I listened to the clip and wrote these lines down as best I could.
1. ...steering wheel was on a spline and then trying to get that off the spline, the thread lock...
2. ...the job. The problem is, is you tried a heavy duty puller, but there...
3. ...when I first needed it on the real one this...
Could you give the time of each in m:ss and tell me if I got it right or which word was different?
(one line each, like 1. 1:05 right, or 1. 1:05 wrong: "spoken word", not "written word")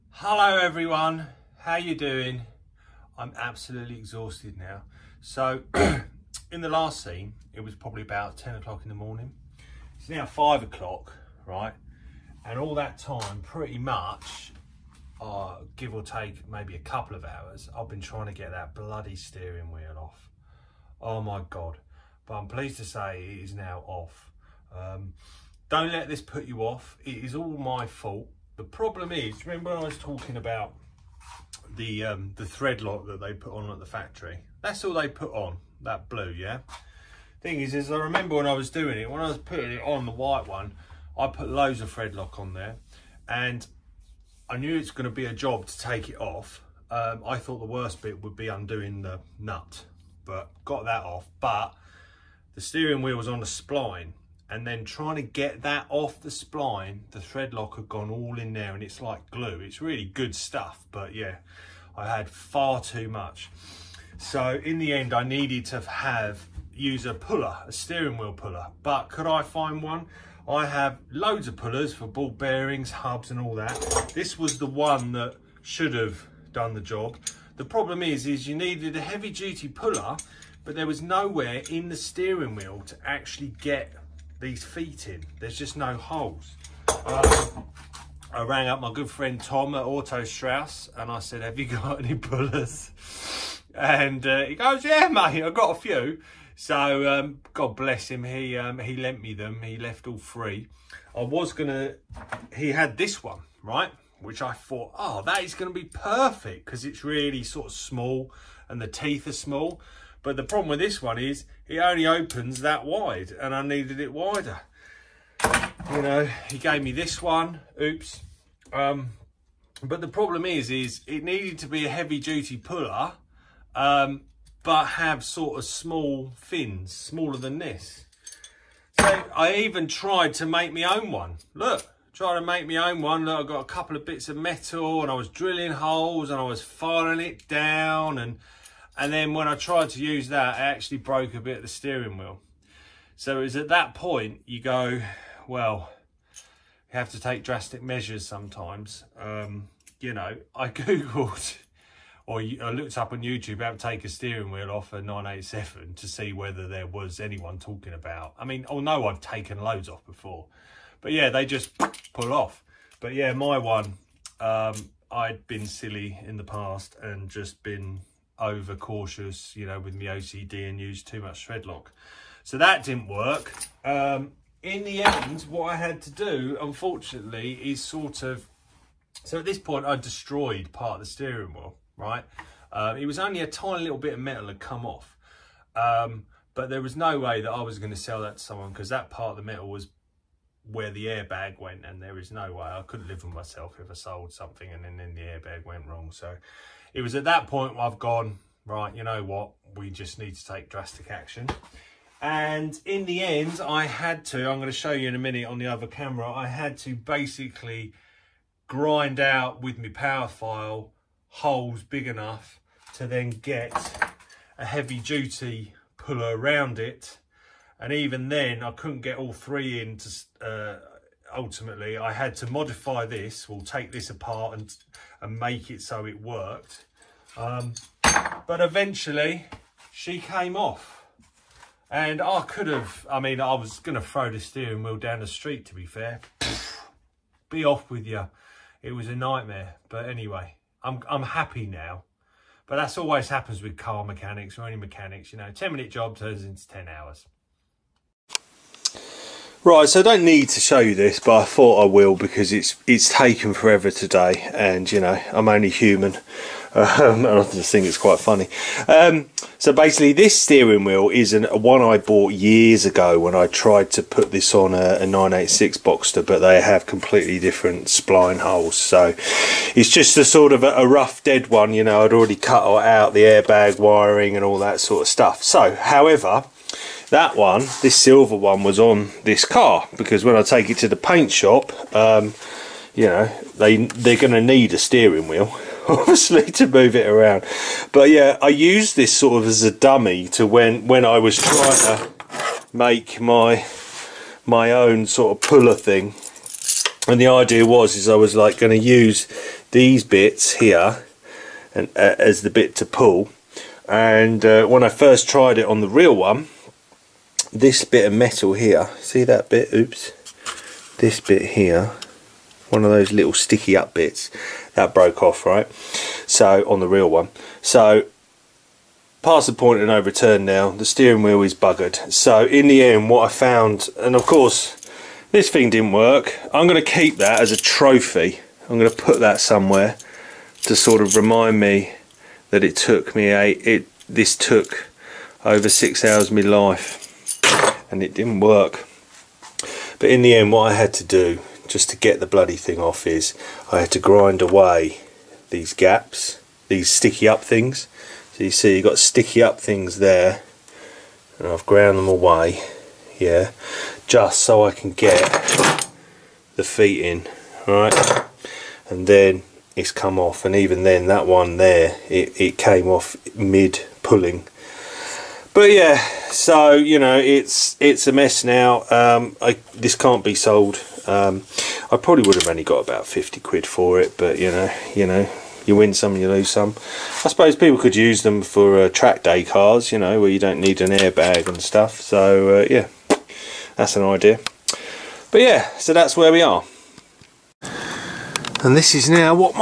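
1. 0:52 right
2. 1:16 wrong: "needed", not "tried"
3. 5:04 wrong: "tried", not "needed".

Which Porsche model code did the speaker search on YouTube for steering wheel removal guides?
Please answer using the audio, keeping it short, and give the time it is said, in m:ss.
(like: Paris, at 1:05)
987, at 2:34.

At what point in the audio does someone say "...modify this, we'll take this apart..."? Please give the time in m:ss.
3:42.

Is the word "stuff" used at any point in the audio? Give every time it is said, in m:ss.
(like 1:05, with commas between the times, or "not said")
1:00, 4:35, 6:21.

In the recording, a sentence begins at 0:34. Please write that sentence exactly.
That's all they put on, that blue, yeah?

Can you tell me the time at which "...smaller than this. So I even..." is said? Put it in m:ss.
2:06.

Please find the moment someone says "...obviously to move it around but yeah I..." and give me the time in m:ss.
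4:45.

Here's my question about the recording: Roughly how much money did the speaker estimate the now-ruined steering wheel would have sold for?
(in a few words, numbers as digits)
50 quid.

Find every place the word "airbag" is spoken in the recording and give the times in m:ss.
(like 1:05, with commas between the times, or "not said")
3:11, 3:15, 4:33, 6:20.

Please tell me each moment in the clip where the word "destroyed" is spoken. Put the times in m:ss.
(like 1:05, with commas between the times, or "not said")
2:59.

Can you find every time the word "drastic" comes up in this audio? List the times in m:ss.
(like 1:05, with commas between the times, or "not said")
2:27, 3:20.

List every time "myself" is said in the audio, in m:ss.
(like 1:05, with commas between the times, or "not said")
3:13.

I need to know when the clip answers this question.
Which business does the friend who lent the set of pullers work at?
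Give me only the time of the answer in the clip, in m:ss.
1:29.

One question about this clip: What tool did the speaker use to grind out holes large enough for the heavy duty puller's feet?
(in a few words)
Power file.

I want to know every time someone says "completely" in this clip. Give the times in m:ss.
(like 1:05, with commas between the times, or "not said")
4:26.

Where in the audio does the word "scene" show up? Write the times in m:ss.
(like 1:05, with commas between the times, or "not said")
0:07.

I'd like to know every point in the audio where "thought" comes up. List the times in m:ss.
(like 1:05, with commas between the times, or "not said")
0:47, 1:44, 4:11.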